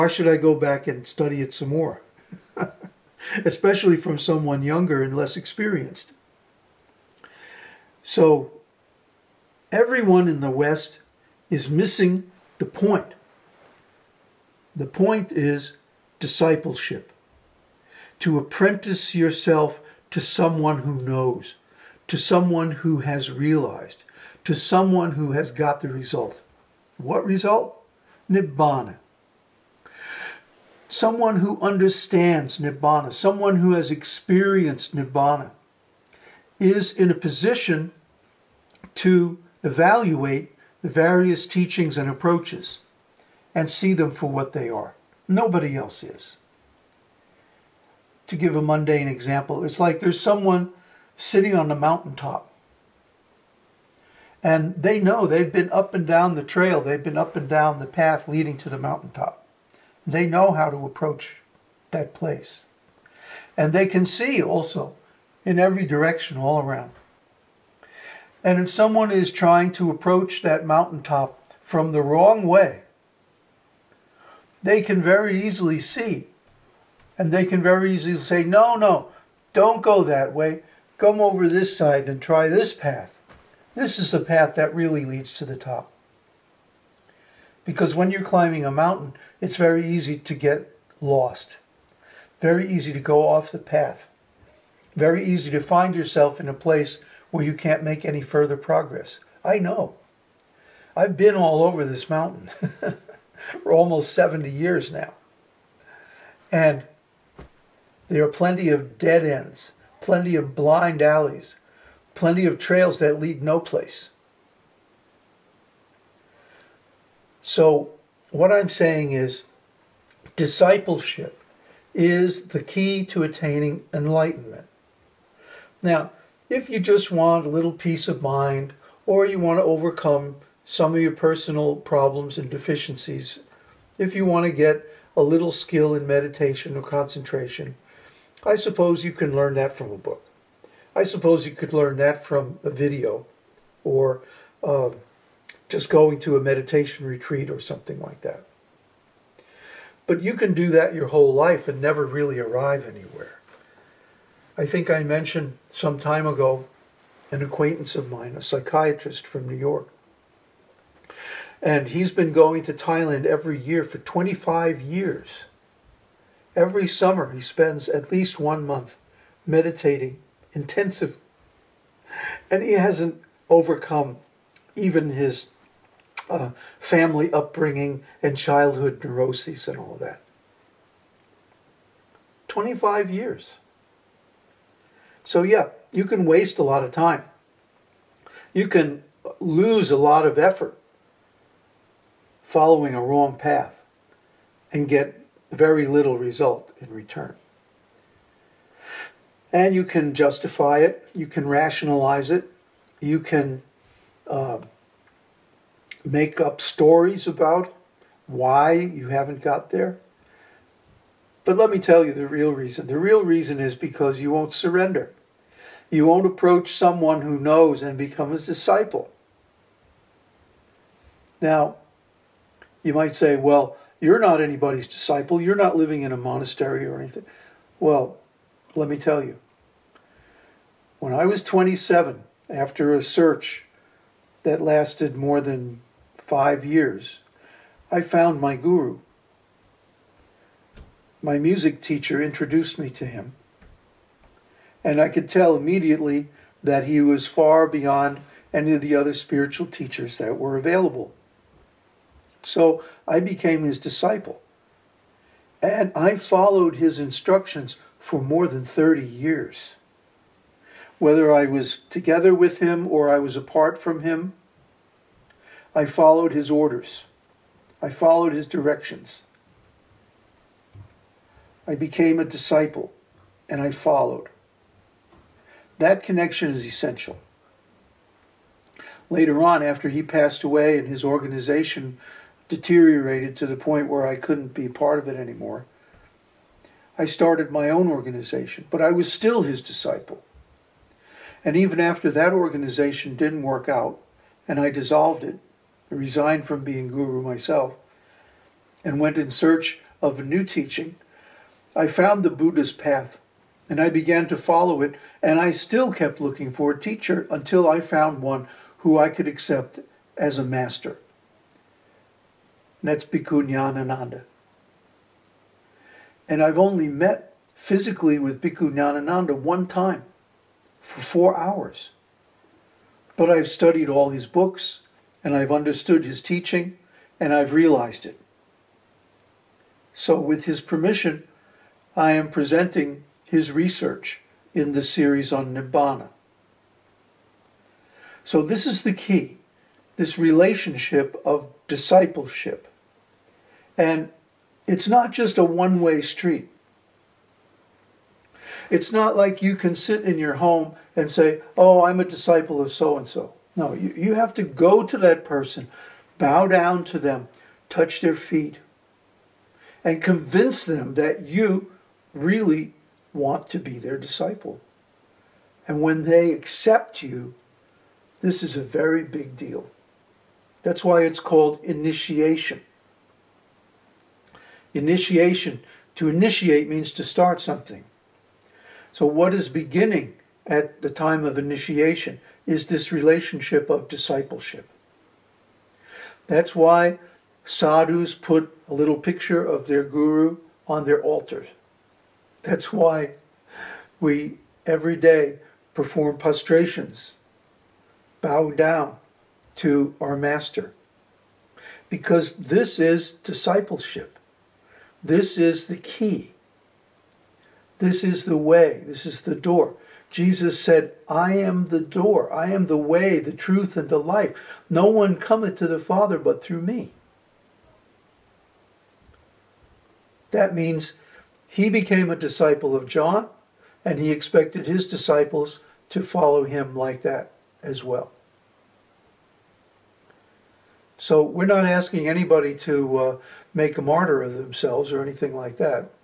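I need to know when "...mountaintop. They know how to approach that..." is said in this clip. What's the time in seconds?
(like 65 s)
58 s.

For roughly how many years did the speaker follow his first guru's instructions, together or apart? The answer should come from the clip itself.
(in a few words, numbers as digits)
30.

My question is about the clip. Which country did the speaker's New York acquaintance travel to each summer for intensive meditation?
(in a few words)
Thailand.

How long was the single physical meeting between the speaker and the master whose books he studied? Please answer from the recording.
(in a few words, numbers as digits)
4 hours.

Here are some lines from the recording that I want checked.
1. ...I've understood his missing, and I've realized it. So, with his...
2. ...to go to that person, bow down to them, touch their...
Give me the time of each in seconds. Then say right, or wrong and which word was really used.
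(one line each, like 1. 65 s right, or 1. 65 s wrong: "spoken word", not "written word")
1. 325 s wrong: "teaching", not "missing"
2. 354 s right.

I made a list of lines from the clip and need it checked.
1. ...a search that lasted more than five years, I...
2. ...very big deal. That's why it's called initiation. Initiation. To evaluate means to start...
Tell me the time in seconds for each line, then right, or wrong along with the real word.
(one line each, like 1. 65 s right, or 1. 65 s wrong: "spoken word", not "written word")
1. 232 s right
2. 368 s wrong: "initiate", not "evaluate".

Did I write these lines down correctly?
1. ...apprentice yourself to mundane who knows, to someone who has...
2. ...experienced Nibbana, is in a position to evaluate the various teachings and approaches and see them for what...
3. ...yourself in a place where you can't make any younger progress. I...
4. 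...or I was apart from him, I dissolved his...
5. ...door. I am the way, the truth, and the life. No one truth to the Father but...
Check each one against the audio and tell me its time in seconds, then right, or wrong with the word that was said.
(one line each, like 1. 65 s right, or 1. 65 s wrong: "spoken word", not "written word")
1. 18 s wrong: "someone", not "mundane"
2. 33 s right
3. 95 s wrong: "further", not "younger"
4. 262 s wrong: "followed", not "dissolved"
5. 411 s wrong: "cometh", not "truth".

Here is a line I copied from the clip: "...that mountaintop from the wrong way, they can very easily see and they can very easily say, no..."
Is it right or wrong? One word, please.
right.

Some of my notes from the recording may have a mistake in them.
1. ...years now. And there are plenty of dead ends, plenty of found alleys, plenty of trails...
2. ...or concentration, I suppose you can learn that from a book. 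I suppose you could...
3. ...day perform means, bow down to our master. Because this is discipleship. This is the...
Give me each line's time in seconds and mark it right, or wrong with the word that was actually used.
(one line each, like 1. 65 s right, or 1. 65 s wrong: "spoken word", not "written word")
1. 104 s wrong: "blind", not "found"
2. 136 s right
3. 394 s wrong: "prostrations", not "means".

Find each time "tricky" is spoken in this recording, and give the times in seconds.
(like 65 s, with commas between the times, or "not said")
not said.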